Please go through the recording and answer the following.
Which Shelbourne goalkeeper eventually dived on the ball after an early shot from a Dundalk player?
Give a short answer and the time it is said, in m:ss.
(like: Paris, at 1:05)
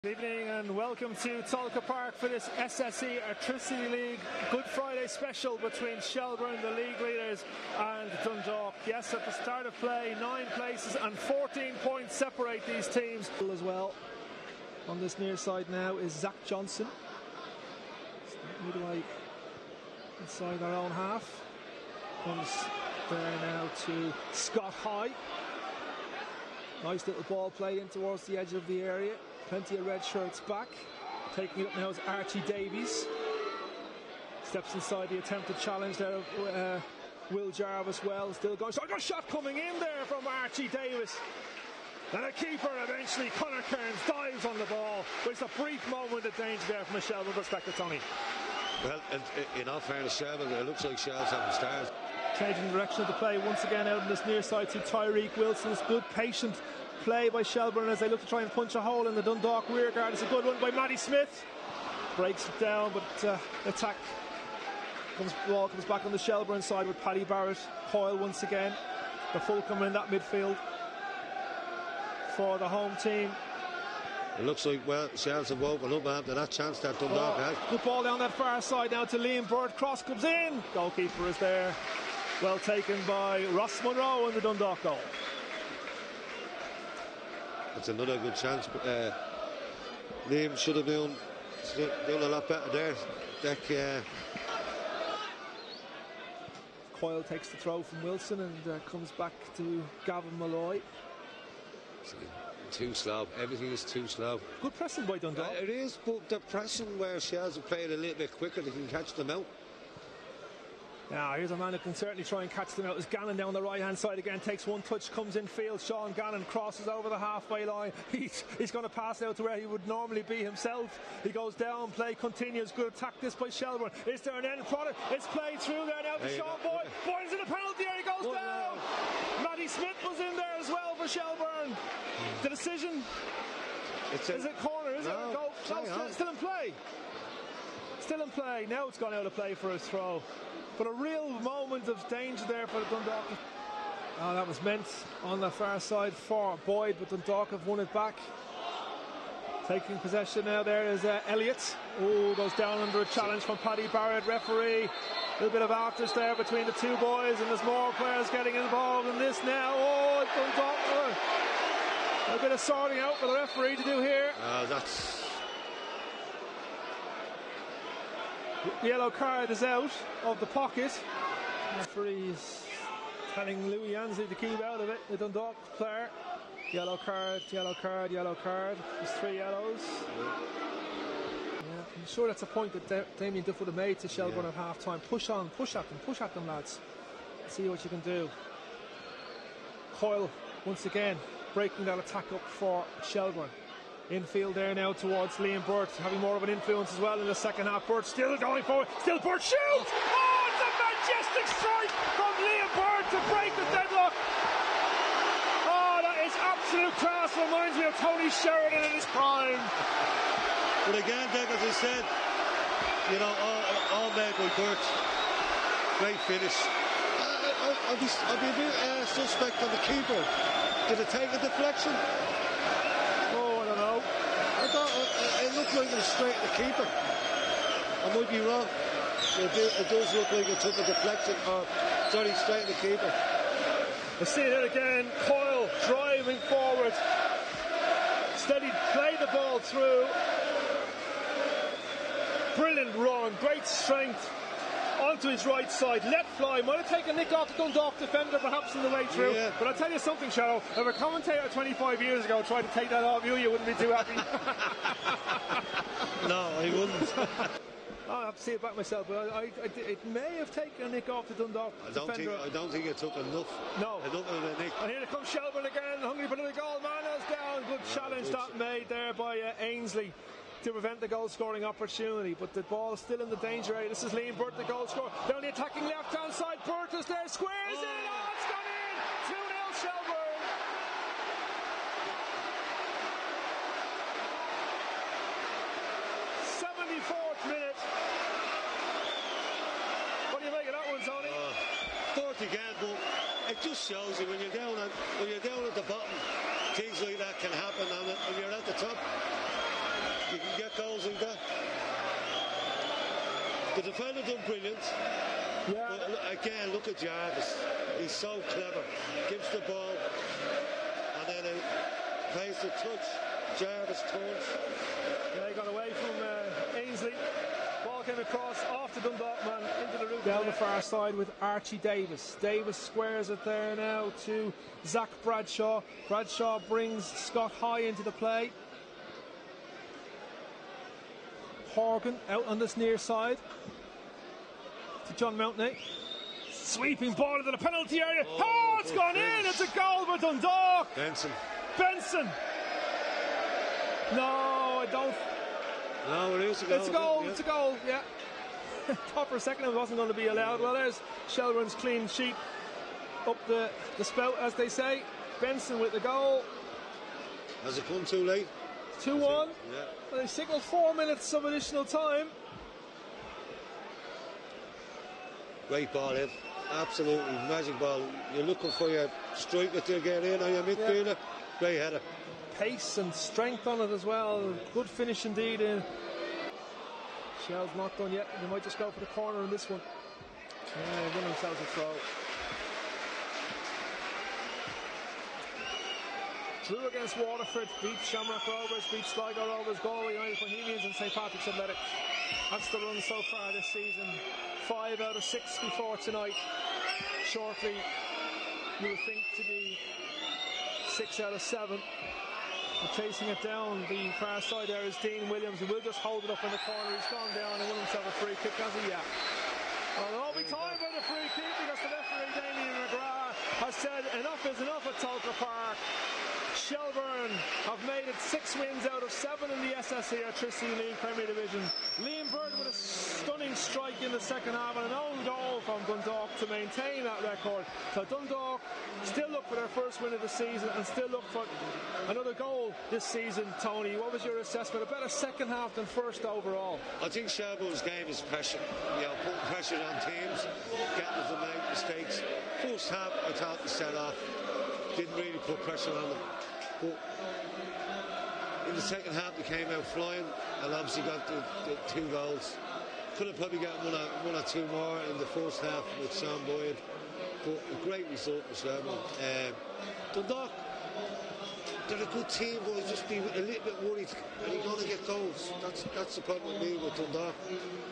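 Conor Kearns, at 0:43.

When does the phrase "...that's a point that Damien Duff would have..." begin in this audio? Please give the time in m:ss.
3:02.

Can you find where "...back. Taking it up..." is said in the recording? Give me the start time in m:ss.
0:30.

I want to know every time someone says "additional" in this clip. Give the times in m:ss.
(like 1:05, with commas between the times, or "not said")
6:01.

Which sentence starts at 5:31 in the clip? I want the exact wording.
Horgan out on this near side to John Mountney.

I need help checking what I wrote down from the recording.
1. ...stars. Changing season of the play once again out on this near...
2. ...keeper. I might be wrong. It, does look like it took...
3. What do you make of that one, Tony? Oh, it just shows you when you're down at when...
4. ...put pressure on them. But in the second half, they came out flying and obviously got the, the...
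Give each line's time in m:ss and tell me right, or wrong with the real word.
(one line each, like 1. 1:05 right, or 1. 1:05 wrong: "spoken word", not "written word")
1. 0:51 wrong: "direction", not "season"
2. 3:46 right
3. 4:50 right
4. 7:25 right.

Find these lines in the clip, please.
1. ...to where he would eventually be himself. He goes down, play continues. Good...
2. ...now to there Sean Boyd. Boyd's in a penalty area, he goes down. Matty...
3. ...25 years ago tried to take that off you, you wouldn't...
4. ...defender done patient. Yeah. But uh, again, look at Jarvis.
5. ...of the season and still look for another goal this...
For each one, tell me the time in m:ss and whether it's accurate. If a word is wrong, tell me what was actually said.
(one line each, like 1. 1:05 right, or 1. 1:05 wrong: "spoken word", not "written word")
1. 1:59 wrong: "normally", not "eventually"
2. 2:06 right
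3. 4:11 right
4. 5:03 wrong: "brilliant", not "patient"
5. 7:10 right.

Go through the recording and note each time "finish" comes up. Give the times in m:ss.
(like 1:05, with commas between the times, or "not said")
3:36, 6:14.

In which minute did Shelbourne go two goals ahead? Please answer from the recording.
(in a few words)
74th.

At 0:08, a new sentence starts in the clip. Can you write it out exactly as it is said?
Yes, at the start of play, nine places and 14 points separate these teams.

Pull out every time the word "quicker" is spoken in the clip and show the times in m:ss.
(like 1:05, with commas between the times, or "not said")
1:48.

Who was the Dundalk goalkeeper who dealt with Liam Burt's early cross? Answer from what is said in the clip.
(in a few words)
Ross Monroe.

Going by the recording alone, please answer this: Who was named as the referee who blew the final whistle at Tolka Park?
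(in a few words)
Damien McGrath.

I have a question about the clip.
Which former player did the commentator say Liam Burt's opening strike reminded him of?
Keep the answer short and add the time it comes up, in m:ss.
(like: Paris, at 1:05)
Tony Sheridan, at 3:28.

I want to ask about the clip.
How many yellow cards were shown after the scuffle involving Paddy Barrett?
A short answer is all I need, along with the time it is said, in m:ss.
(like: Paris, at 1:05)
3, at 2:59.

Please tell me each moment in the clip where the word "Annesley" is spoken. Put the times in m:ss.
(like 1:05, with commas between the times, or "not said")
2:53, 4:29, 5:16.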